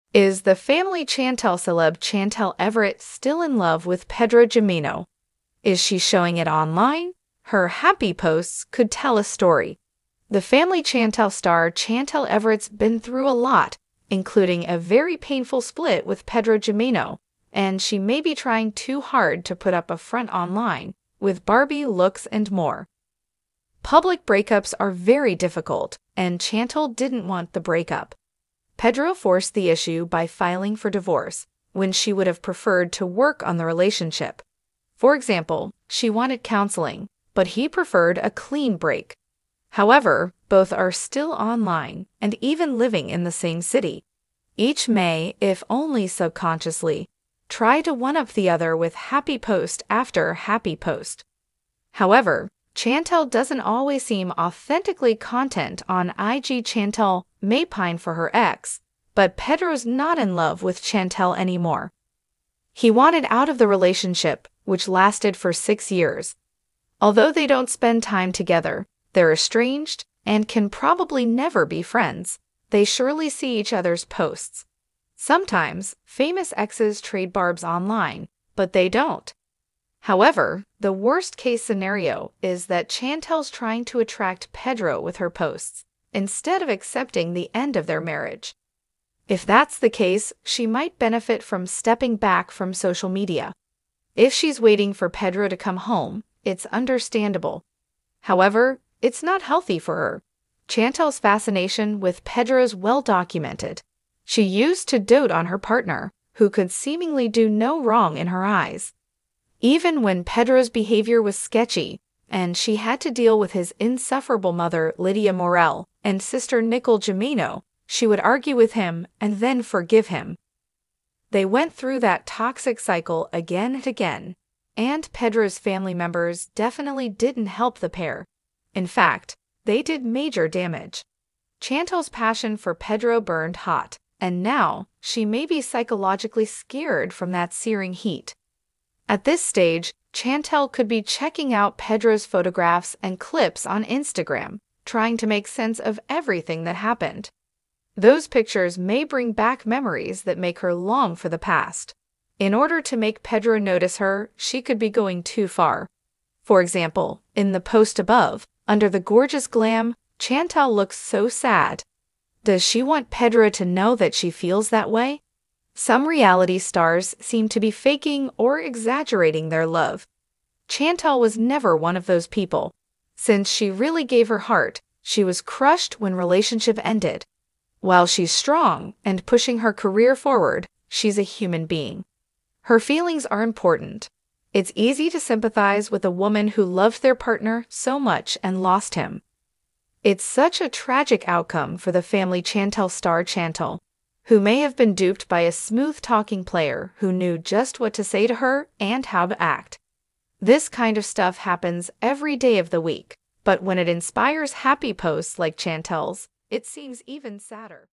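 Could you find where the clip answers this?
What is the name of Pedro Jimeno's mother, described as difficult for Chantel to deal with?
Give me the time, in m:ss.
1:54.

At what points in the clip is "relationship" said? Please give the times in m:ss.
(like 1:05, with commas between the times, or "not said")
0:33, 1:03, 2:56.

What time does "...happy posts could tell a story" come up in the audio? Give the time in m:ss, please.
0:07.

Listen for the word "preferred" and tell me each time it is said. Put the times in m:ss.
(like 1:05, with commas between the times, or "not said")
0:32, 0:37.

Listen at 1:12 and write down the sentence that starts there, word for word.
They surely see each other's posts.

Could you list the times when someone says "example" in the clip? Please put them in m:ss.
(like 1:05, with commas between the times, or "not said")
0:35, 2:36.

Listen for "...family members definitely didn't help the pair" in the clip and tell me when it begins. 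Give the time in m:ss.
2:05.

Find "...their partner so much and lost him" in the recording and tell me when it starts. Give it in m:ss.
3:07.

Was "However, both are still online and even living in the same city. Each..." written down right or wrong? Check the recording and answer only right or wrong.
right.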